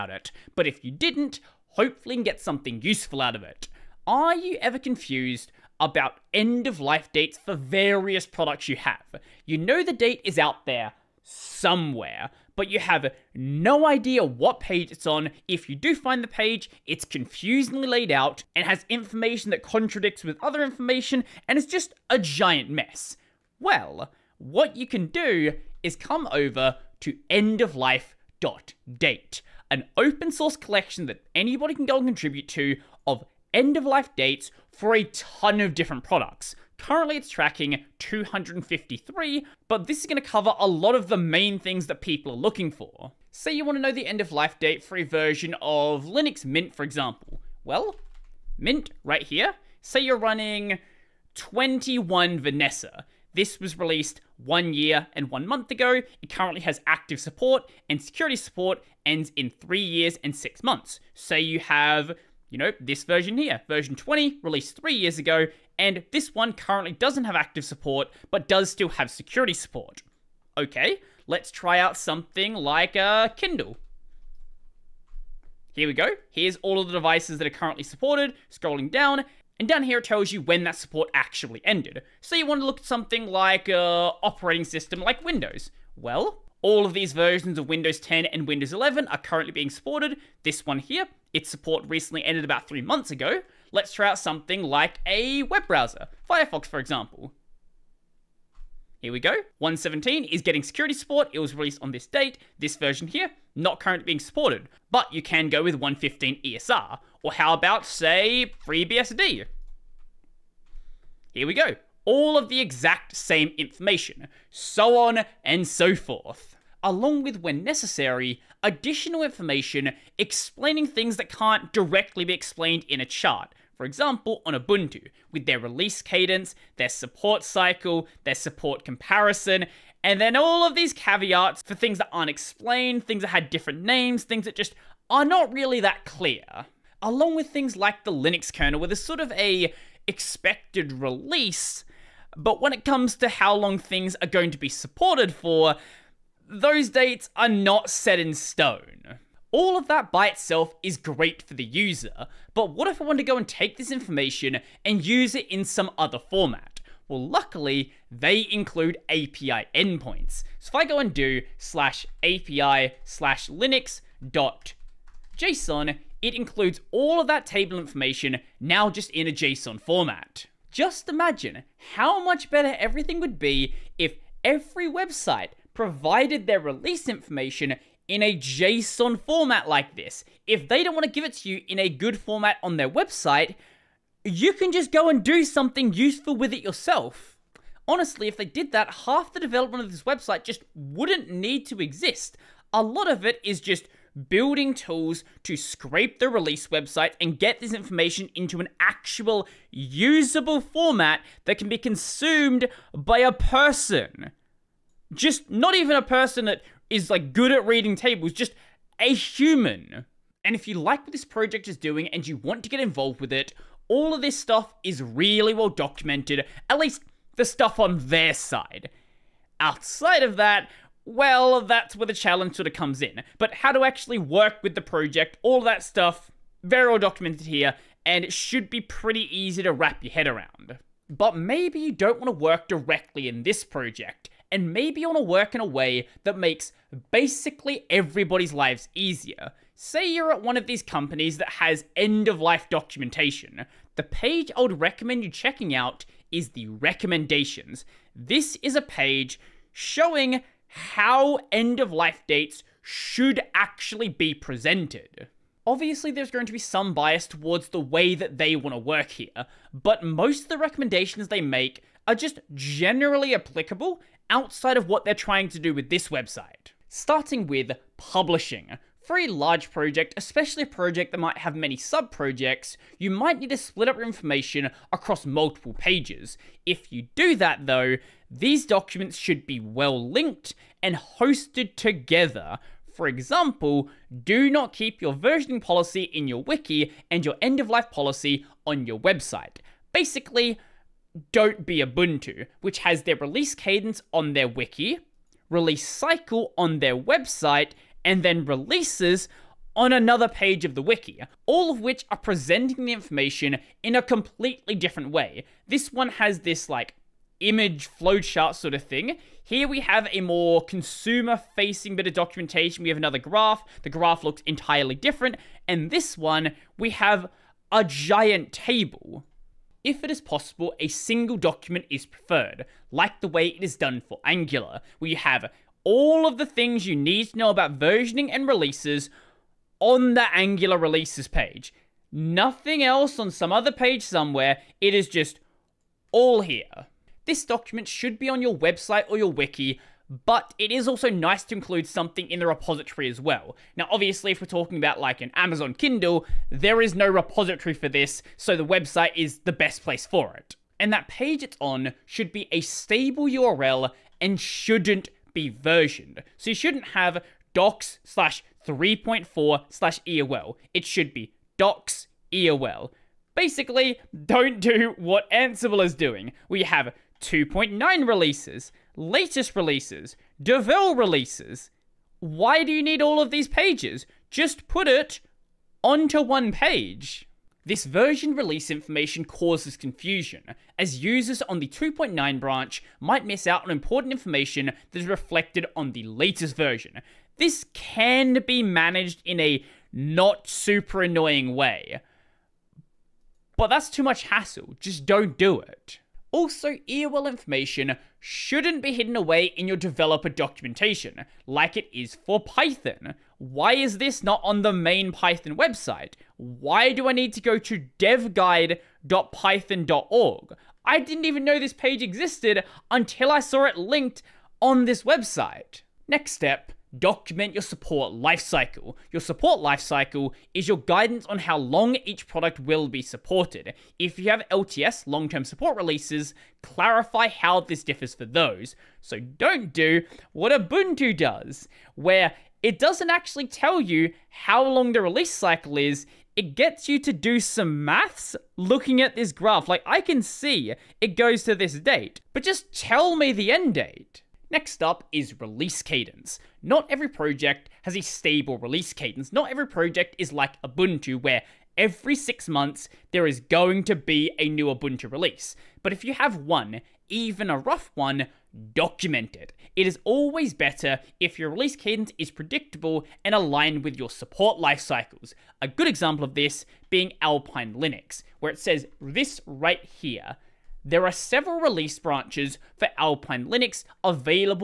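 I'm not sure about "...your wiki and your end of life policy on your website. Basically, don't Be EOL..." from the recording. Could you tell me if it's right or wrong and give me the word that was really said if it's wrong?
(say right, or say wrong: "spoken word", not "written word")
wrong: "Ubuntu", not "EOL".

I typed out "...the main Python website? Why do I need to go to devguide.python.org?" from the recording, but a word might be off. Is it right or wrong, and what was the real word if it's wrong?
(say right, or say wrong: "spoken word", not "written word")
right.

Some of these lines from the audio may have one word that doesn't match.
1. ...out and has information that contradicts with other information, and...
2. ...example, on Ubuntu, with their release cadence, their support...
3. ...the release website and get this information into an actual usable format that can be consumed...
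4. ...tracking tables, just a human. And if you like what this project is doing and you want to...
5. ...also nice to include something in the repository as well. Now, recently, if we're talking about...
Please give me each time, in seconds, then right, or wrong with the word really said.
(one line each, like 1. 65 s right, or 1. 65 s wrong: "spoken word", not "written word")
1. 18 s right
2. 123 s right
3. 196 s right
4. 207 s wrong: "reading", not "tracking"
5. 340 s wrong: "obviously", not "recently".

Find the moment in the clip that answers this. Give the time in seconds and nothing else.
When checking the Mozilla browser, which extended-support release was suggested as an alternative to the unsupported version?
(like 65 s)
105 s.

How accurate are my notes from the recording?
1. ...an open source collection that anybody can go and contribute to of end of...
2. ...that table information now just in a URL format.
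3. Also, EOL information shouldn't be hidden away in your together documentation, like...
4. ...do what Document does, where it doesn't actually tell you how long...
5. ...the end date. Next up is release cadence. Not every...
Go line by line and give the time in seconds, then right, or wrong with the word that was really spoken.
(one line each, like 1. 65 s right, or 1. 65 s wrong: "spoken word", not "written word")
1. 29 s right
2. 167 s wrong: "JSON", not "URL"
3. 396 s wrong: "developer", not "together"
4. 429 s wrong: "Ubuntu", not "Document"
5. 443 s right.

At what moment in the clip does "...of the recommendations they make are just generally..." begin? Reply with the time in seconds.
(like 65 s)
260 s.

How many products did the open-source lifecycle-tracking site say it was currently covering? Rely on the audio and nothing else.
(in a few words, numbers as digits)
253.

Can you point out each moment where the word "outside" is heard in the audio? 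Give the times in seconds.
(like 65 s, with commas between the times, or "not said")
219 s, 264 s.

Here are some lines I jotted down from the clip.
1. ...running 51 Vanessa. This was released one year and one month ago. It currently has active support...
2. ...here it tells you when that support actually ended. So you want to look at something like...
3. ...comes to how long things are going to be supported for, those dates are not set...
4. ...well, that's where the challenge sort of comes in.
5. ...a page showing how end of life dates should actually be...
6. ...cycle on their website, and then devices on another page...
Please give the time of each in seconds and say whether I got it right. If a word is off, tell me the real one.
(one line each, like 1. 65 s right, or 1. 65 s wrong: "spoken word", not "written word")
1. 50 s wrong: "21", not "51"
2. 79 s right
3. 142 s right
4. 221 s right
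5. 248 s right
6. 295 s wrong: "releases", not "devices".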